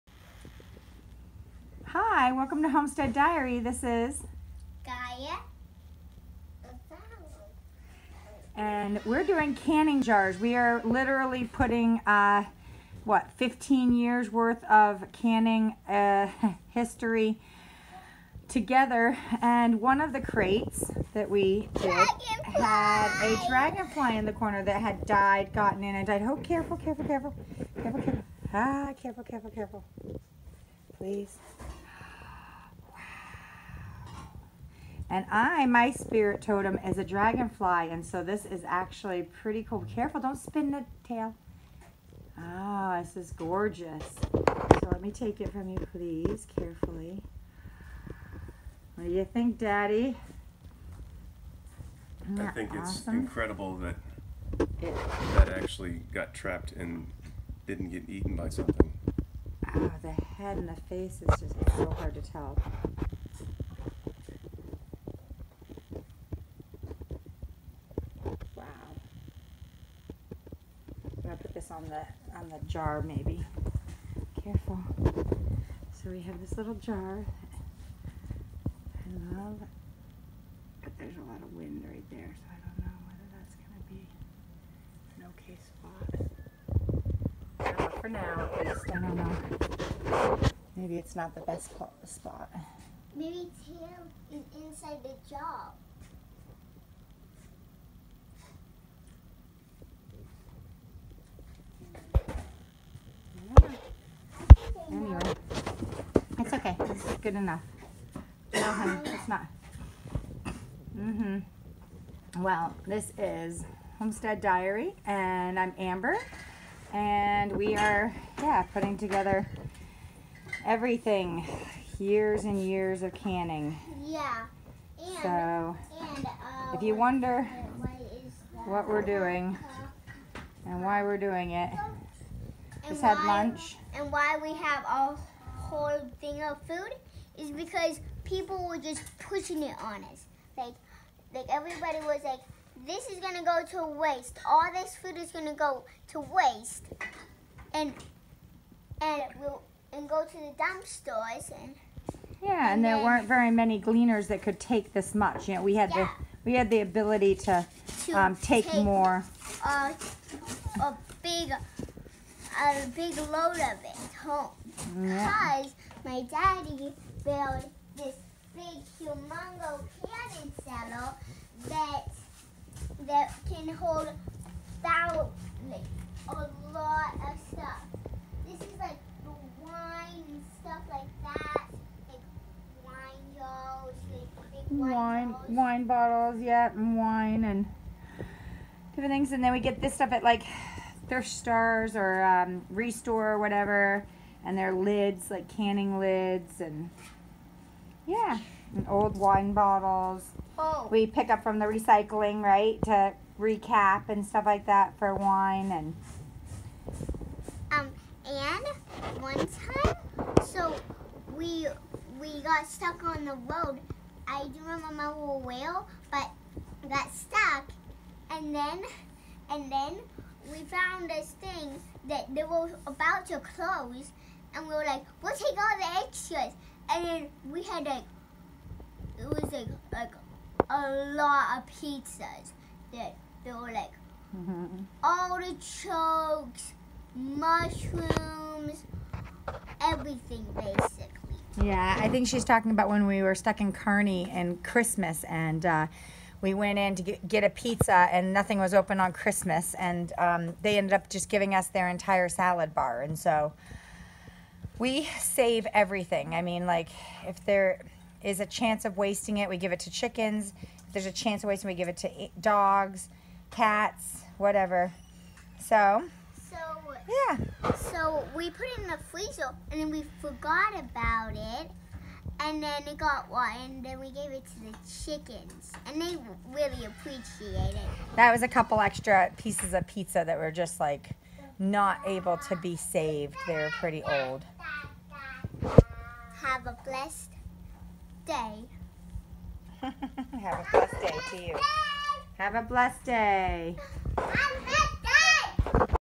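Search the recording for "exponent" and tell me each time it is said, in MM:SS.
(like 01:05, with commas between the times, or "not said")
not said.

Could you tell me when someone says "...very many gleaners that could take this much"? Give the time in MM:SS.
02:33.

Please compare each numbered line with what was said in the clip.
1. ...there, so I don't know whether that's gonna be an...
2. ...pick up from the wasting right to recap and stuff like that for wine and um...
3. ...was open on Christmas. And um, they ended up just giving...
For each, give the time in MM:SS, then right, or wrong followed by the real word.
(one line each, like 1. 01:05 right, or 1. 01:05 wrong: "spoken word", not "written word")
1. 01:22 right
2. 03:21 wrong: "recycling", not "wasting"
3. 04:08 right.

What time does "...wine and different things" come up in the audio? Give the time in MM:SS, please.
03:06.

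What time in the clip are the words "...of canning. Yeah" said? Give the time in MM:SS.
02:03.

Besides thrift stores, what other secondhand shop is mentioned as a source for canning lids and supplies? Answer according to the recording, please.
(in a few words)
ReStore.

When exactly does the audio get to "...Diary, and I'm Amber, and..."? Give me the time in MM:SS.
01:54.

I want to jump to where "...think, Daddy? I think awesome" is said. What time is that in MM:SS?
00:49.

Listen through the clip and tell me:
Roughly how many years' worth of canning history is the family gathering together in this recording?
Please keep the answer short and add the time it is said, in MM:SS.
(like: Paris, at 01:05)
15 years, at 00:13.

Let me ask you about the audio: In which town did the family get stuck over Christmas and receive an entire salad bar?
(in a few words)
Kearney.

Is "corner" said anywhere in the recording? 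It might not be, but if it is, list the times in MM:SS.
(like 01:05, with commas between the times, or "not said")
00:24.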